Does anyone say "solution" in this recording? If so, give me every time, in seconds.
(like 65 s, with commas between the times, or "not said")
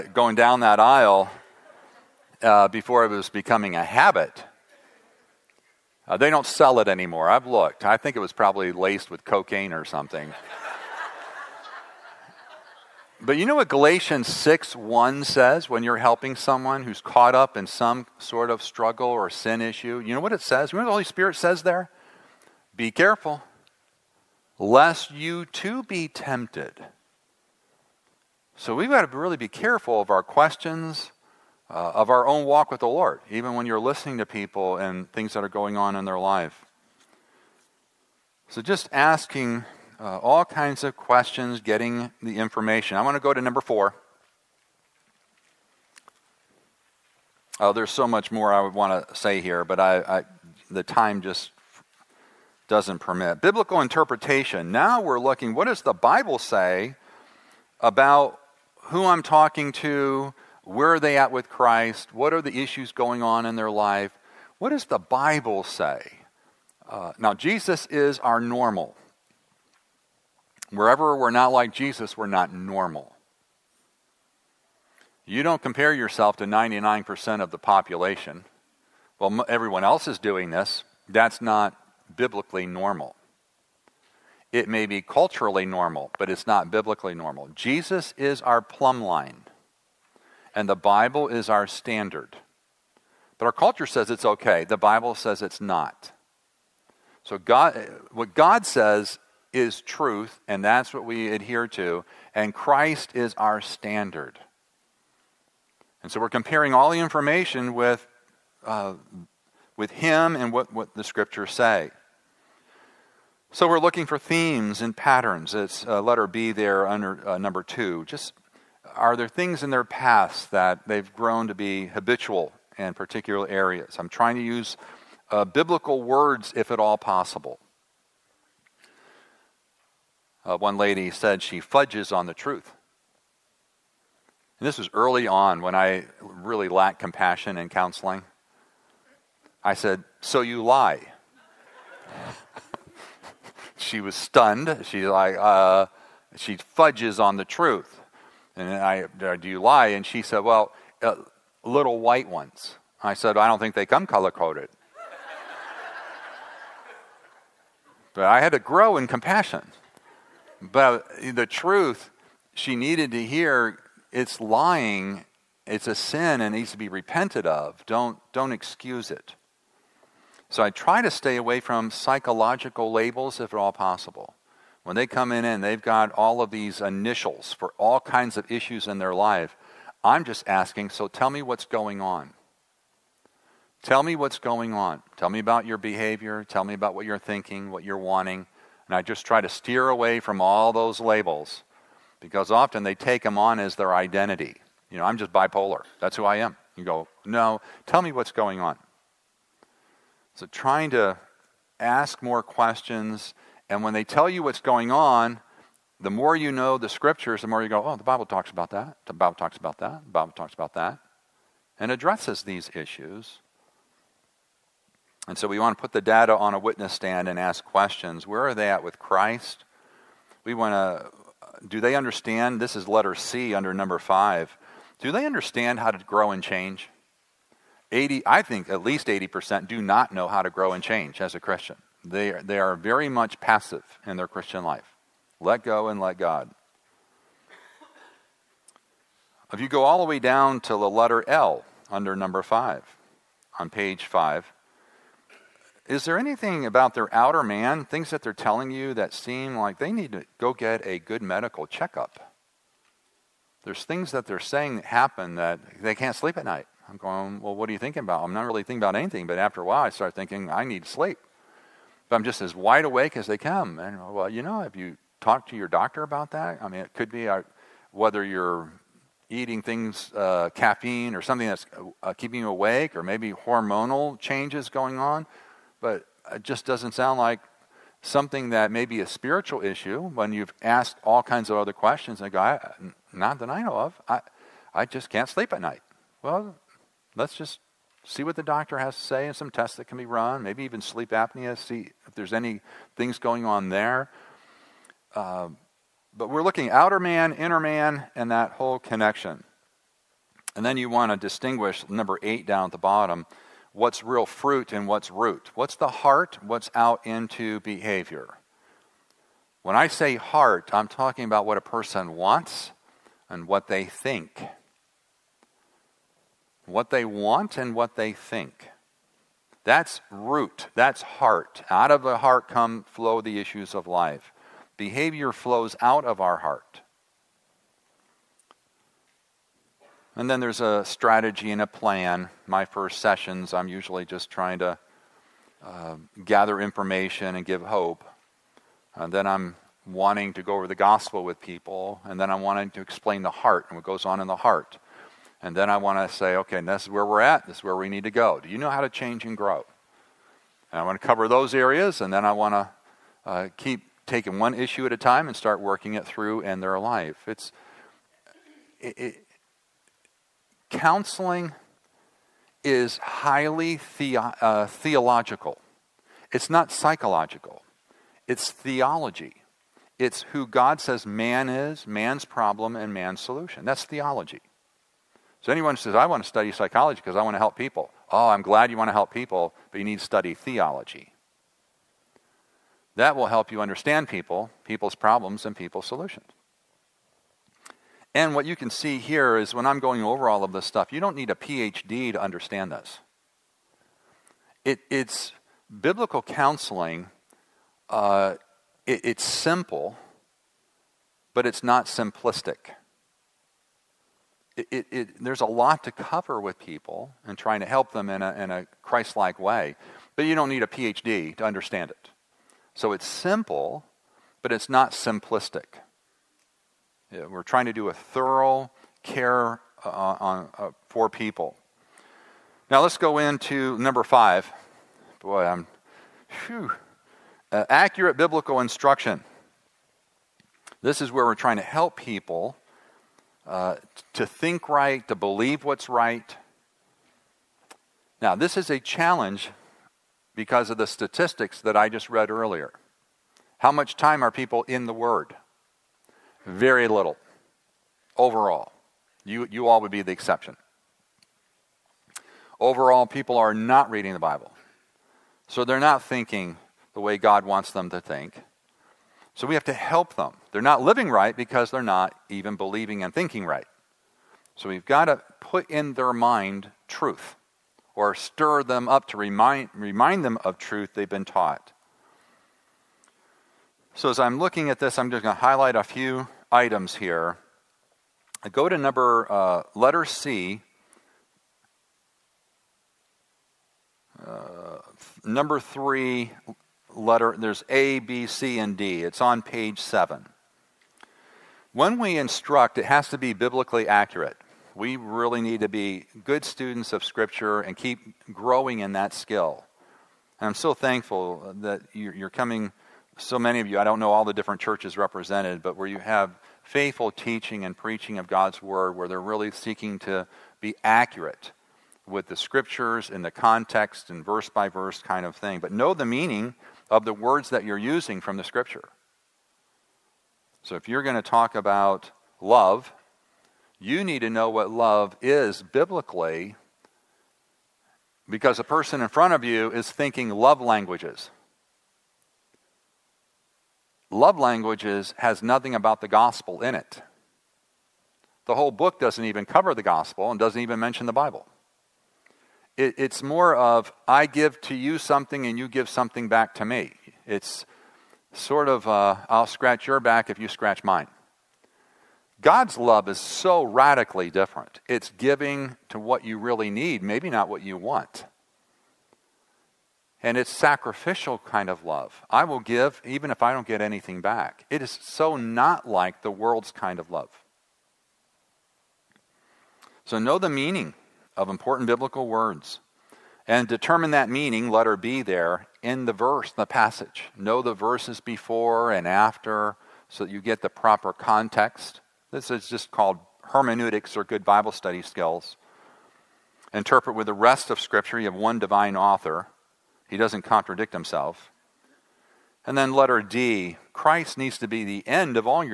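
373 s, 385 s.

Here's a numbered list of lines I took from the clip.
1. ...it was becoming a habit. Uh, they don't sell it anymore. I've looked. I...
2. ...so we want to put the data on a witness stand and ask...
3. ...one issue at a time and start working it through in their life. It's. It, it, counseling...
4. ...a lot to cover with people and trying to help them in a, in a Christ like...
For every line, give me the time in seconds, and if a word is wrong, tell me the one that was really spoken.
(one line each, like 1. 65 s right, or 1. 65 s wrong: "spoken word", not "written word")
1. 3 s right
2. 215 s right
3. 354 s right
4. 405 s right.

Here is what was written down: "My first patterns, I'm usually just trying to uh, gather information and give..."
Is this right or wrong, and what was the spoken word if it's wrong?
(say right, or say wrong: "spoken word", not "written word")
wrong: "sessions", not "patterns".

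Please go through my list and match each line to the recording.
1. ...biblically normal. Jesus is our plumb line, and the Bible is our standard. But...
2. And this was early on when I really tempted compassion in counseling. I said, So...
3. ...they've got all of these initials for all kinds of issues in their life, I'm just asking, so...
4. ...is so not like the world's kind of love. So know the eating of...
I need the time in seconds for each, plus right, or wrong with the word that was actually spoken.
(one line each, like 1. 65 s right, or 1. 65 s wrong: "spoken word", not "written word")
1. 86 s right
2. 134 s wrong: "lacked", not "tempted"
3. 175 s right
4. 564 s wrong: "meaning", not "eating".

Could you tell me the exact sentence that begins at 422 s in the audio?
Now let's go into number five.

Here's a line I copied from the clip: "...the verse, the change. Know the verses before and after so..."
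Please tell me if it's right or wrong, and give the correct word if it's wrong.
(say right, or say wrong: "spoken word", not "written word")
wrong: "passage", not "change".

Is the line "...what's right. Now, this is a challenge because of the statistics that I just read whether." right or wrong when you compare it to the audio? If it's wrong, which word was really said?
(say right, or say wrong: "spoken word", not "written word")
wrong: "earlier", not "whether".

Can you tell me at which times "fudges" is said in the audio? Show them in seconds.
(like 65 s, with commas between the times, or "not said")
131 s, 146 s.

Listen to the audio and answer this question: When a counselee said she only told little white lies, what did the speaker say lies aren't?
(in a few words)
color coded.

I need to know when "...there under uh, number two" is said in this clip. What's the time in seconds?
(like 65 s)
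116 s.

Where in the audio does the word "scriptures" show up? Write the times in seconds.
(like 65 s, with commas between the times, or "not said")
111 s, 206 s, 497 s, 512 s, 518 s, 587 s.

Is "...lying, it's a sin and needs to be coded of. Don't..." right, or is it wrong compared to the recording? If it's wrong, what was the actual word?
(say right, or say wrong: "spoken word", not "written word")
wrong: "repented", not "coded".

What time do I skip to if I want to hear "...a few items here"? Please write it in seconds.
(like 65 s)
475 s.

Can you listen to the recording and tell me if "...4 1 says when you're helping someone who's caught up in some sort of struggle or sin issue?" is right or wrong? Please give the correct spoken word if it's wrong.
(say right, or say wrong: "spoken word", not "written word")
wrong: "6", not "4".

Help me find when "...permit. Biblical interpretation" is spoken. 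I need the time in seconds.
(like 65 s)
52 s.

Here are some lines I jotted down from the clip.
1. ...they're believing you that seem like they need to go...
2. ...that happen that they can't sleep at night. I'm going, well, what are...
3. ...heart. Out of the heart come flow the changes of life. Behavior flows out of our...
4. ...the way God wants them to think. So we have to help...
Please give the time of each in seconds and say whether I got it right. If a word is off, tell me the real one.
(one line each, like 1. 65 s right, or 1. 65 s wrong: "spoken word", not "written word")
1. 248 s wrong: "telling", not "believing"
2. 254 s right
3. 321 s wrong: "issues", not "changes"
4. 456 s right.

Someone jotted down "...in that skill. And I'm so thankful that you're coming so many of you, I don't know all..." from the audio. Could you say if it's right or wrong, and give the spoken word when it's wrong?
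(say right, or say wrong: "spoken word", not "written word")
right.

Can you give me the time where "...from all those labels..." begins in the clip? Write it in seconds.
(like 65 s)
190 s.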